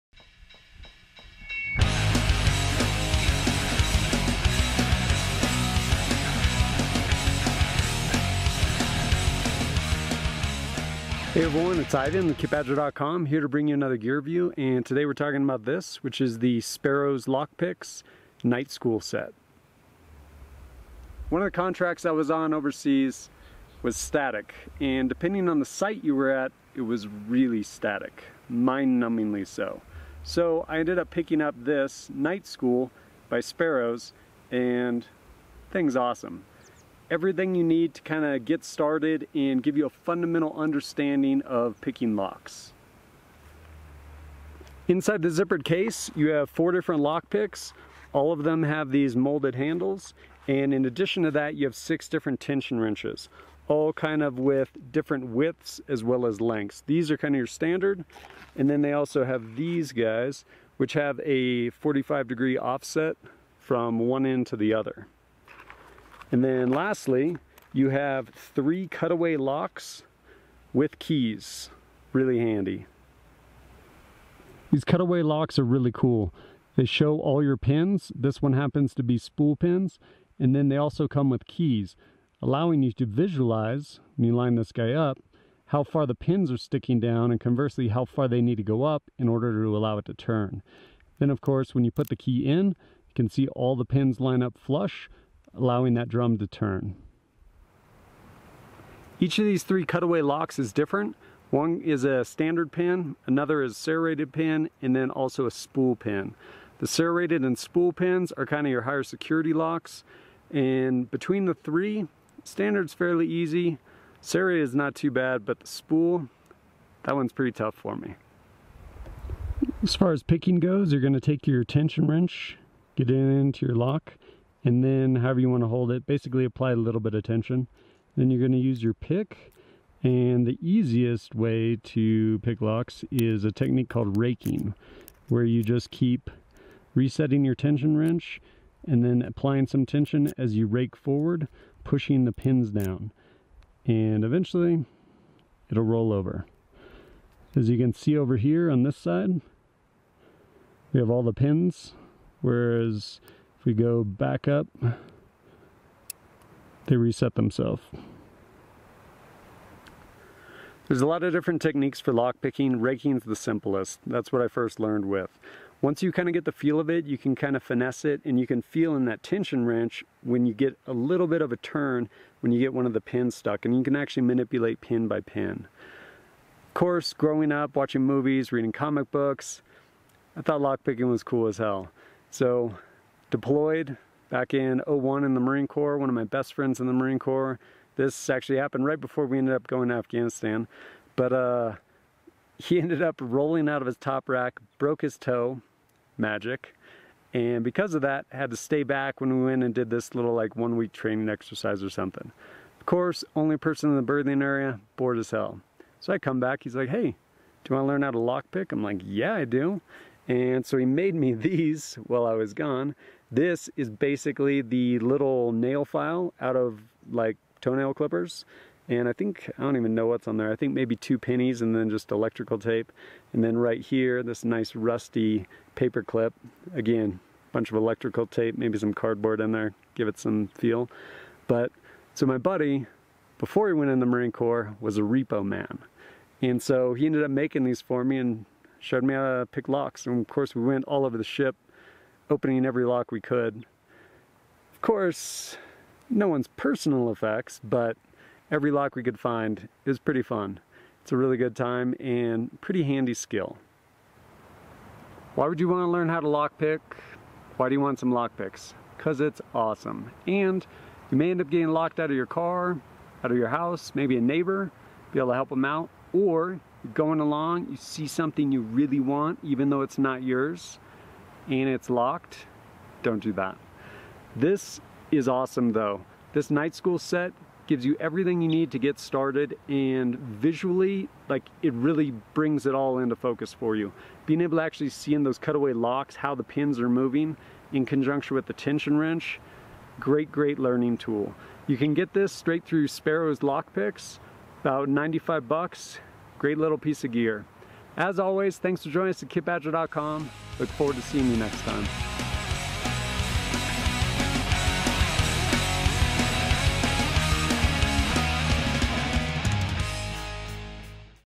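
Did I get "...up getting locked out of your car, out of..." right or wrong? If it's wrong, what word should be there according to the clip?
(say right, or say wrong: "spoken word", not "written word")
right.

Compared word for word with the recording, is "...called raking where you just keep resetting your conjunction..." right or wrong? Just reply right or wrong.
wrong.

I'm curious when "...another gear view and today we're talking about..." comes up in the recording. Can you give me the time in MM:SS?
00:13.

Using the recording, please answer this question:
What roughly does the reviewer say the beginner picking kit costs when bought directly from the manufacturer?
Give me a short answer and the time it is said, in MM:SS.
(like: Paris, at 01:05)
95 bucks, at 04:54.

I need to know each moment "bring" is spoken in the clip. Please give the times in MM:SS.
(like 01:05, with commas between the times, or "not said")
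00:13, 04:42.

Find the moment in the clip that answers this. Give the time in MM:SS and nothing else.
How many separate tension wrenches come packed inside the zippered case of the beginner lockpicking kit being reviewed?
00:51.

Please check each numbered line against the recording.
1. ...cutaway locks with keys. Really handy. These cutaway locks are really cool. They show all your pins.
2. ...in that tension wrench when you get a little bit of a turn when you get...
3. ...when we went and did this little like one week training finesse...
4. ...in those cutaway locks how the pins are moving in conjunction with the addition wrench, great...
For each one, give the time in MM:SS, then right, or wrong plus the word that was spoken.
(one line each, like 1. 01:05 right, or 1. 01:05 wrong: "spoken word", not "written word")
1. 01:08 right
2. 02:48 right
3. 03:19 wrong: "exercise", not "finesse"
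4. 04:45 wrong: "tension", not "addition".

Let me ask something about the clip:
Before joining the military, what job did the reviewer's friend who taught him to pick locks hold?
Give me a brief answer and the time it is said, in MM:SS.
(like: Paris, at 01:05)
repo man, at 03:55.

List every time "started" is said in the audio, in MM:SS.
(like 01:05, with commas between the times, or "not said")
00:38, 04:38.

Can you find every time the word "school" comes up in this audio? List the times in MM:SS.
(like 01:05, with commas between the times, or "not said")
00:18, 00:32, 04:36.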